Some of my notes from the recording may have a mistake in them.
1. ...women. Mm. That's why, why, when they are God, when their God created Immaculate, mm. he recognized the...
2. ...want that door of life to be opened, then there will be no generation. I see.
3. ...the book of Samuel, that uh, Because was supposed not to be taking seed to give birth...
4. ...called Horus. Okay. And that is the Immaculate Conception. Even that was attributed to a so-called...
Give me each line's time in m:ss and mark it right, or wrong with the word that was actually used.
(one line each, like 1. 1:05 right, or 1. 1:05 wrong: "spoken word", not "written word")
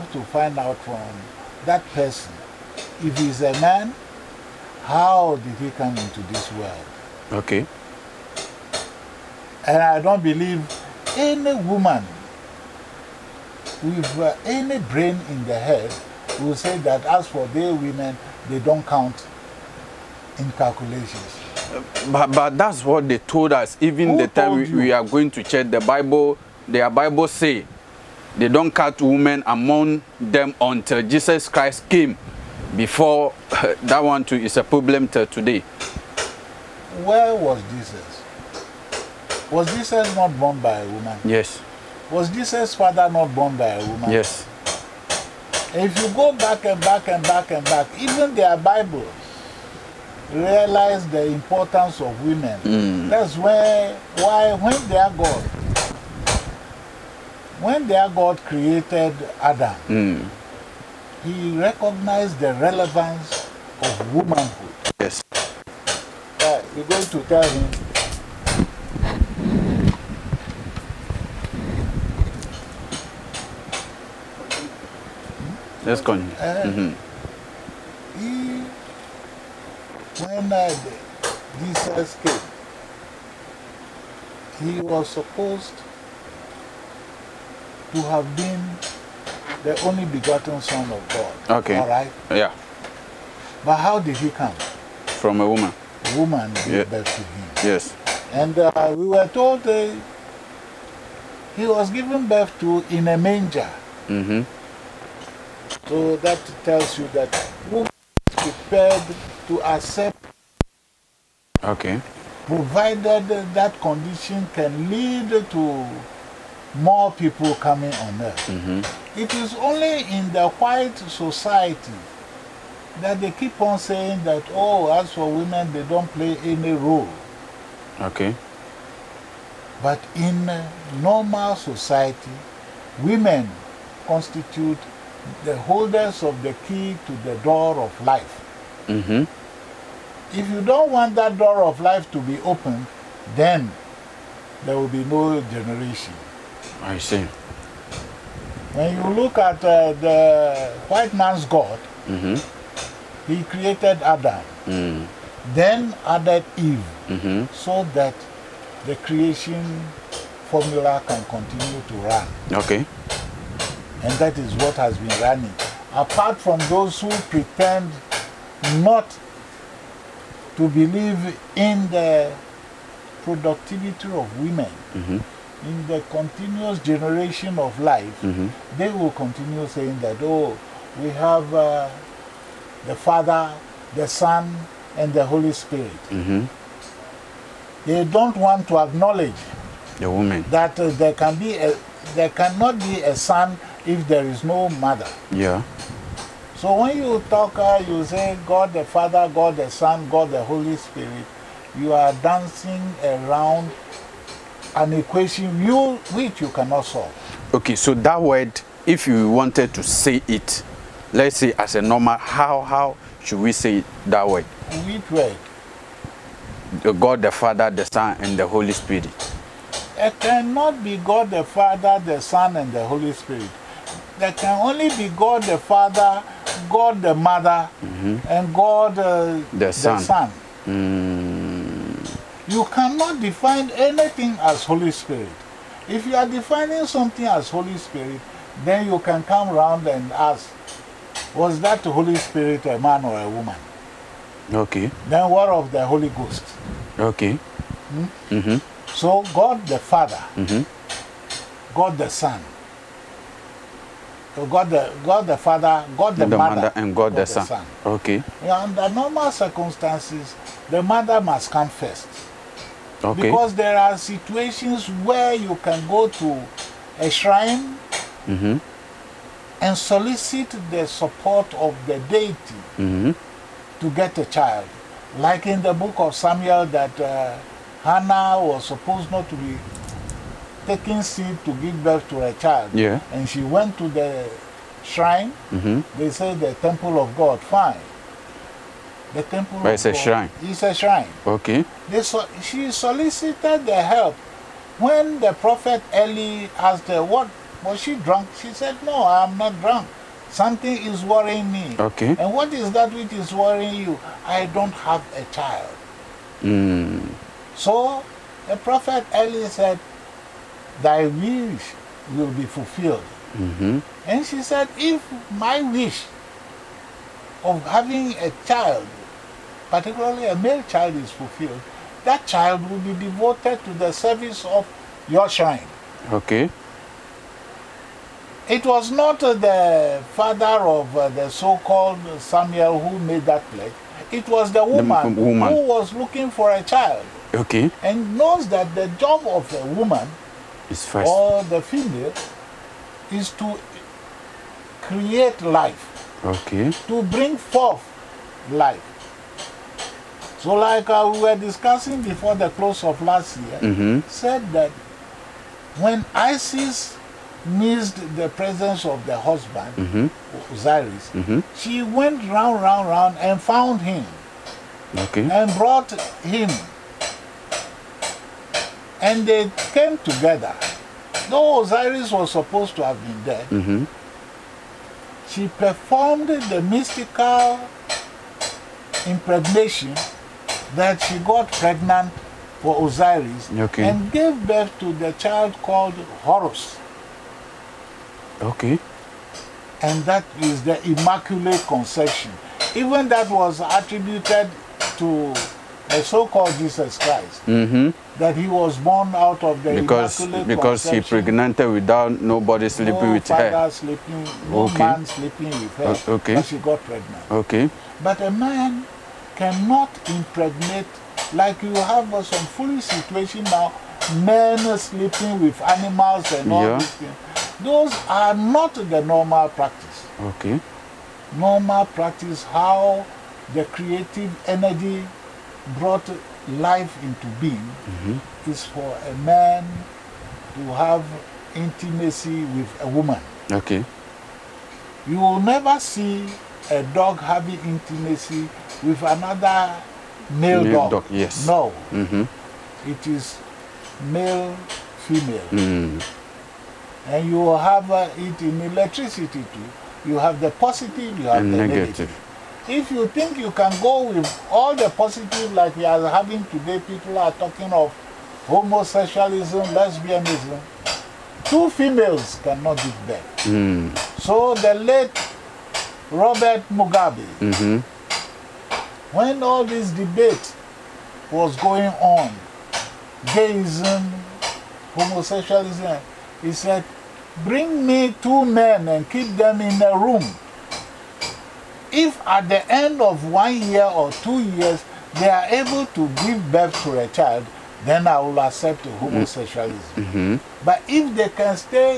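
1. 0:52 wrong: "Adam", not "Immaculate"
2. 2:20 right
3. 4:35 wrong: "Hannah", not "Because"
4. 6:25 right.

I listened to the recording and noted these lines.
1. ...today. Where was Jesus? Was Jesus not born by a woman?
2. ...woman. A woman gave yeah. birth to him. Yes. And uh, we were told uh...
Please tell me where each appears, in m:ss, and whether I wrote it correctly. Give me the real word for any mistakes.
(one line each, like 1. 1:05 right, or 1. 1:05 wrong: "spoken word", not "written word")
1. 0:35 right
2. 1:35 right.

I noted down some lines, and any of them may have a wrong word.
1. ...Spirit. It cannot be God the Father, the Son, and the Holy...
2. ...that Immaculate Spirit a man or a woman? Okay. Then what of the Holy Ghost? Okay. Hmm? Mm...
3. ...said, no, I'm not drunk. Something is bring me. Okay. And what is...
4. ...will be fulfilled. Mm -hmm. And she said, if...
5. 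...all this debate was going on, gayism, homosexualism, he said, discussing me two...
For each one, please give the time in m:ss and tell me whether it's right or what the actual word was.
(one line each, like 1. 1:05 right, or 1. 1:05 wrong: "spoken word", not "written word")
1. 3:38 right
2. 4:01 wrong: "Holy", not "Immaculate"
3. 4:58 wrong: "worrying", not "bring"
4. 5:12 right
5. 7:49 wrong: "bring", not "discussing".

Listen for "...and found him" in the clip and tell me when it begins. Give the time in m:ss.
6:03.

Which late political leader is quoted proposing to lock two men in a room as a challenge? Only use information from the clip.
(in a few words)
Robert Mugabe.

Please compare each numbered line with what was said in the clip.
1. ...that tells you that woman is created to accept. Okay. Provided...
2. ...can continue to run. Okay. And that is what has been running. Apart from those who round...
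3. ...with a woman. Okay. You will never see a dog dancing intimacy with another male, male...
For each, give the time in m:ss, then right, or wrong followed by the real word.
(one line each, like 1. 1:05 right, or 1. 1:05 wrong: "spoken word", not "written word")
1. 1:46 wrong: "prepared", not "created"
2. 2:41 wrong: "pretend", not "round"
3. 7:12 wrong: "having", not "dancing".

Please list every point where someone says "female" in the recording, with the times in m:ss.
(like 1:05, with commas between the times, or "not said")
5:41, 7:25, 7:41.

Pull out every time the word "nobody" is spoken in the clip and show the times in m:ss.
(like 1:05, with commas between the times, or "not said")
6:42.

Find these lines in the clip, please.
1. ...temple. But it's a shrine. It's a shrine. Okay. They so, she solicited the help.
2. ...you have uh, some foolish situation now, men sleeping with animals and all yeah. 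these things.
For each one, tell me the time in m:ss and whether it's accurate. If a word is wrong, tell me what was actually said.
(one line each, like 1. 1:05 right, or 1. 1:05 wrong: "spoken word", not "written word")
1. 4:49 right
2. 6:51 right.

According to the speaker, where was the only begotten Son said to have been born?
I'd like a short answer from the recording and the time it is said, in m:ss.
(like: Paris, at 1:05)
In a manger, at 1:42.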